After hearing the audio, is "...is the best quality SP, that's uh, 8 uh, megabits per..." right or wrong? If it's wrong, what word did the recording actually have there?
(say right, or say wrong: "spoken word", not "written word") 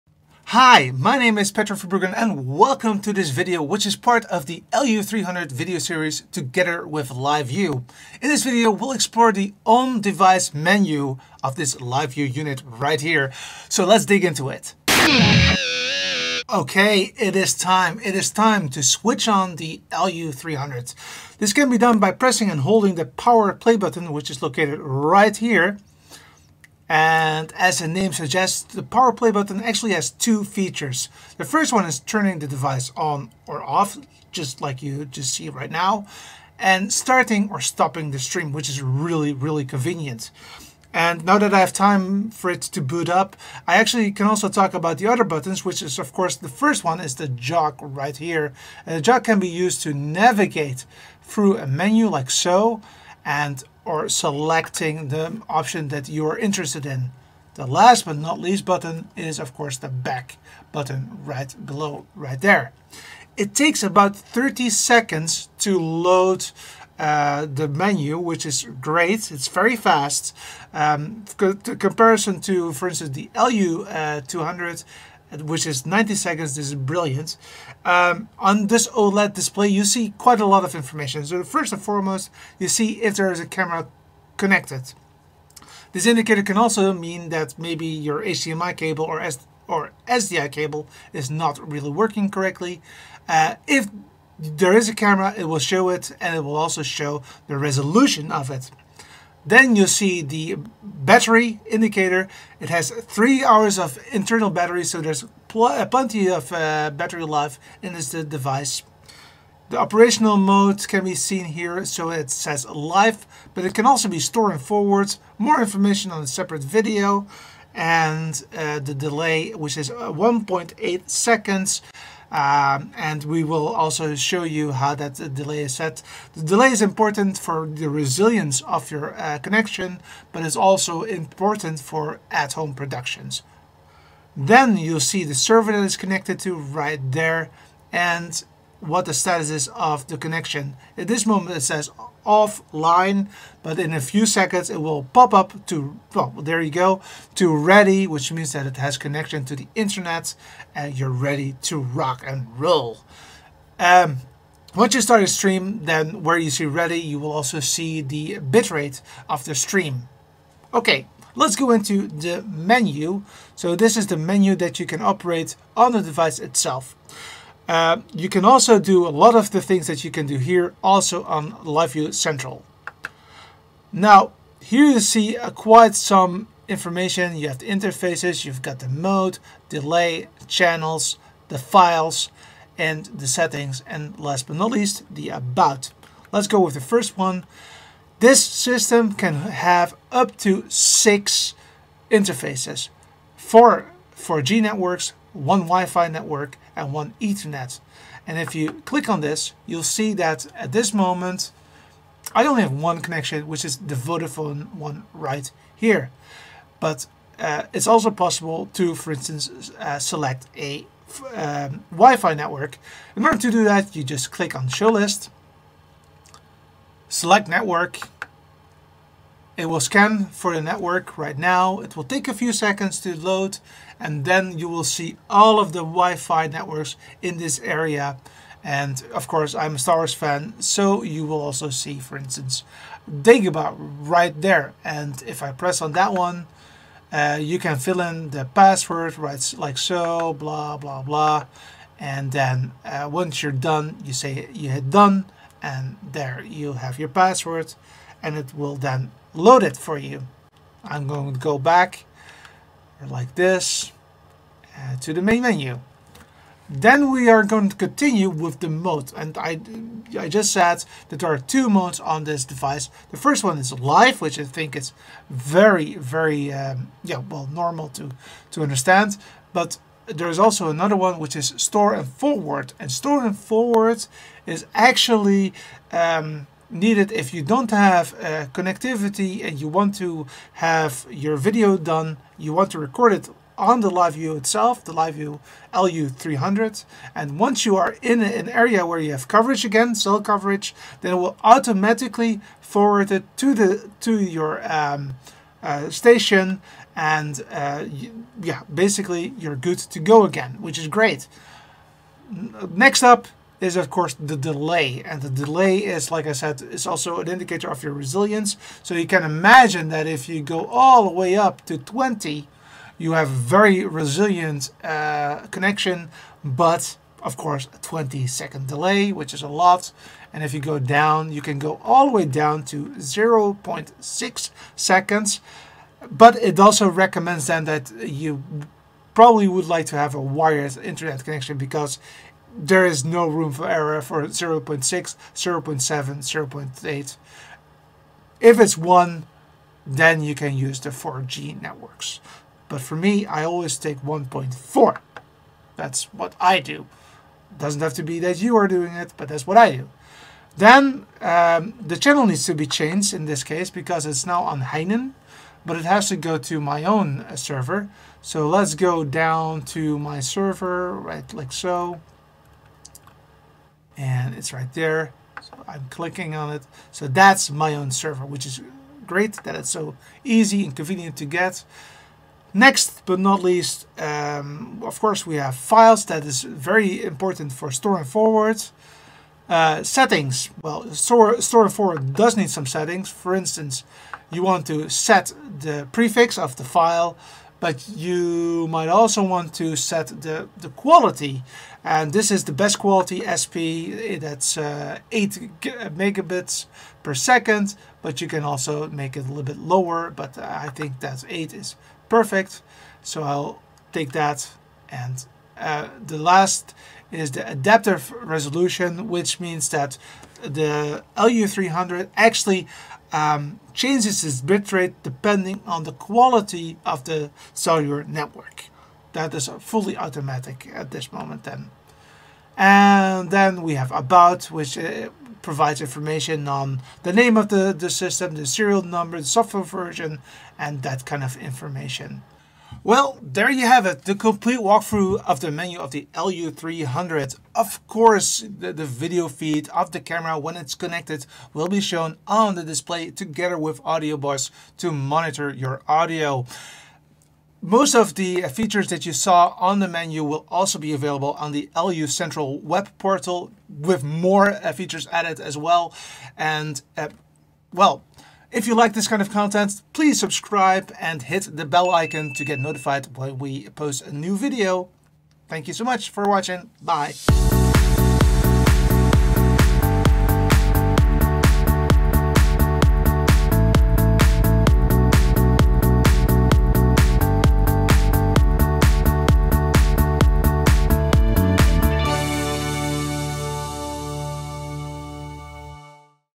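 right.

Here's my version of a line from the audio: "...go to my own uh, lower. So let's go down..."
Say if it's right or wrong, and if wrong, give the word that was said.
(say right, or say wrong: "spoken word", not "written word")
wrong: "server", not "lower".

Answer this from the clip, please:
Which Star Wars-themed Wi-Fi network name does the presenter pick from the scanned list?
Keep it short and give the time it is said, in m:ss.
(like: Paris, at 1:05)
Dagobah, at 3:53.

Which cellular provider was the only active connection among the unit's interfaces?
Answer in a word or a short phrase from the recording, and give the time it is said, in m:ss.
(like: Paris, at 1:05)
Vodafone, at 3:23.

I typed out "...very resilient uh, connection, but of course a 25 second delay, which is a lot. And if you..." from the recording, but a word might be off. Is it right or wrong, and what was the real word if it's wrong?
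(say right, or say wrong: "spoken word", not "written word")
wrong: "20", not "25".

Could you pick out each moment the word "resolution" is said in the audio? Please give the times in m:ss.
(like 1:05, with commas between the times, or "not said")
1:37, 6:48.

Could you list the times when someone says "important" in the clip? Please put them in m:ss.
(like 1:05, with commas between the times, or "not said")
2:06, 2:11, 6:17.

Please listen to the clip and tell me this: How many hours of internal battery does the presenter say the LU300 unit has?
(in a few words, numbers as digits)
3 hours.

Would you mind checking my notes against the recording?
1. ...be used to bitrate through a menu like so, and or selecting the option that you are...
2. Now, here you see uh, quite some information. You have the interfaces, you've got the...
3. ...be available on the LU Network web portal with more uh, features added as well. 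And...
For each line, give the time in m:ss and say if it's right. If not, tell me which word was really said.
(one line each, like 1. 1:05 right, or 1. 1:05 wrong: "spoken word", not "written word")
1. 0:49 wrong: "navigate", not "bitrate"
2. 2:53 right
3. 7:30 wrong: "Central", not "Network".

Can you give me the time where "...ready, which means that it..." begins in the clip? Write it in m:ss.
2:27.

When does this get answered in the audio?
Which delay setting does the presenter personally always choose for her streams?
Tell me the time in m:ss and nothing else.
5:44.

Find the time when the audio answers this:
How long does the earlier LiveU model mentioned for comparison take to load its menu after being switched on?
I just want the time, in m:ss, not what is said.
1:15.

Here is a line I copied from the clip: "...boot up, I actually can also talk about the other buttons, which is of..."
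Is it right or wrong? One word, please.
right.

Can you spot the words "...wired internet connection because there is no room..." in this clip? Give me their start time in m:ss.
5:30.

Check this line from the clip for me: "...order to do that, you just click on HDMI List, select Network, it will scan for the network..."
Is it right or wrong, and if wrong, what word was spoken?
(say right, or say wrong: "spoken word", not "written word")
wrong: "Show", not "HDMI".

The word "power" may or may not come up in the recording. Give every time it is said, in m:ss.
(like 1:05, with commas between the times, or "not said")
0:23, 0:28.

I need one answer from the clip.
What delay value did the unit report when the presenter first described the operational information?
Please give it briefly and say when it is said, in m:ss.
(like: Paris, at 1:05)
1.8 seconds, at 2:00.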